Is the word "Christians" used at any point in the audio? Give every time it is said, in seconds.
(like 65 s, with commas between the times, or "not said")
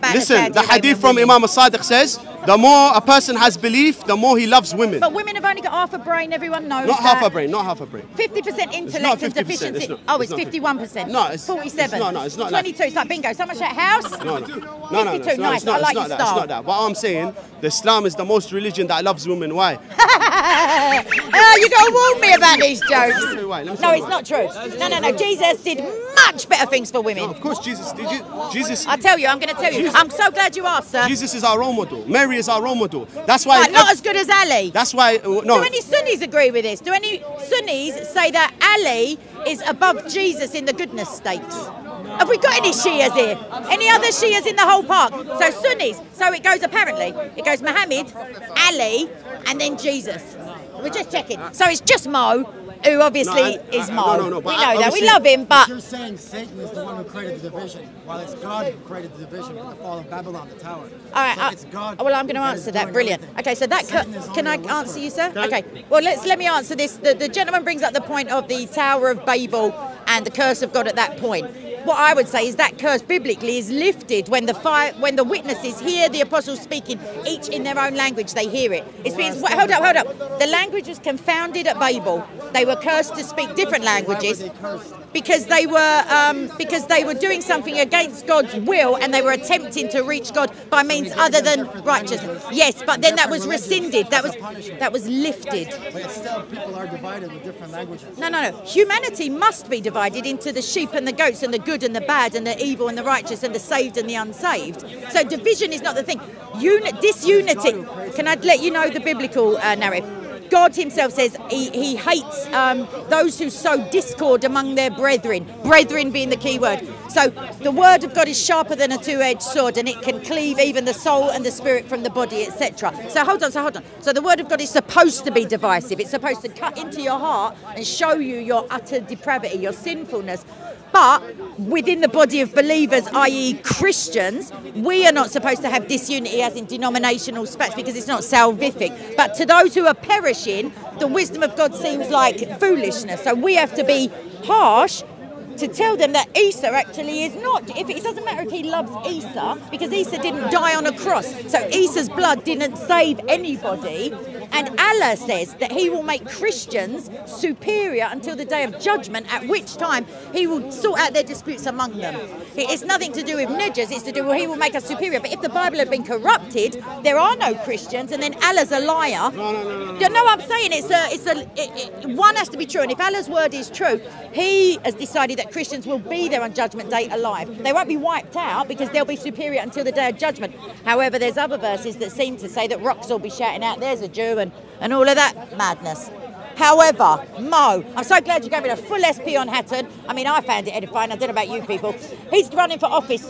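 133 s, 156 s, 167 s, 175 s.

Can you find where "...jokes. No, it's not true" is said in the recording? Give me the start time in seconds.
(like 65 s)
22 s.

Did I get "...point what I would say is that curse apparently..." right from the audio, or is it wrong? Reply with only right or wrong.
wrong.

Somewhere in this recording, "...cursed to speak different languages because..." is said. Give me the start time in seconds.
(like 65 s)
82 s.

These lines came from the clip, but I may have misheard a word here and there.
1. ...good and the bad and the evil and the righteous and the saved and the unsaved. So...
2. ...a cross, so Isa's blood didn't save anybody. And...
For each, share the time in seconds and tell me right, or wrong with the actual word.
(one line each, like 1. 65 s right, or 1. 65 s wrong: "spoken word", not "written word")
1. 101 s right
2. 150 s right.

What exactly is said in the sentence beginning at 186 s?
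However, Mo, I'm so glad you gave me a full SP on Hatun.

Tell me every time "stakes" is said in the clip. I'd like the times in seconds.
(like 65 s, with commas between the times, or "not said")
41 s.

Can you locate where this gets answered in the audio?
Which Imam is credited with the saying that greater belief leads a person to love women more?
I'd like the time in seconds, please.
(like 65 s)
1 s.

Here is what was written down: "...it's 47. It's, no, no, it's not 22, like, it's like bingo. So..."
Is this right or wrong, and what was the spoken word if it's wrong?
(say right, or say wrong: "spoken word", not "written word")
right.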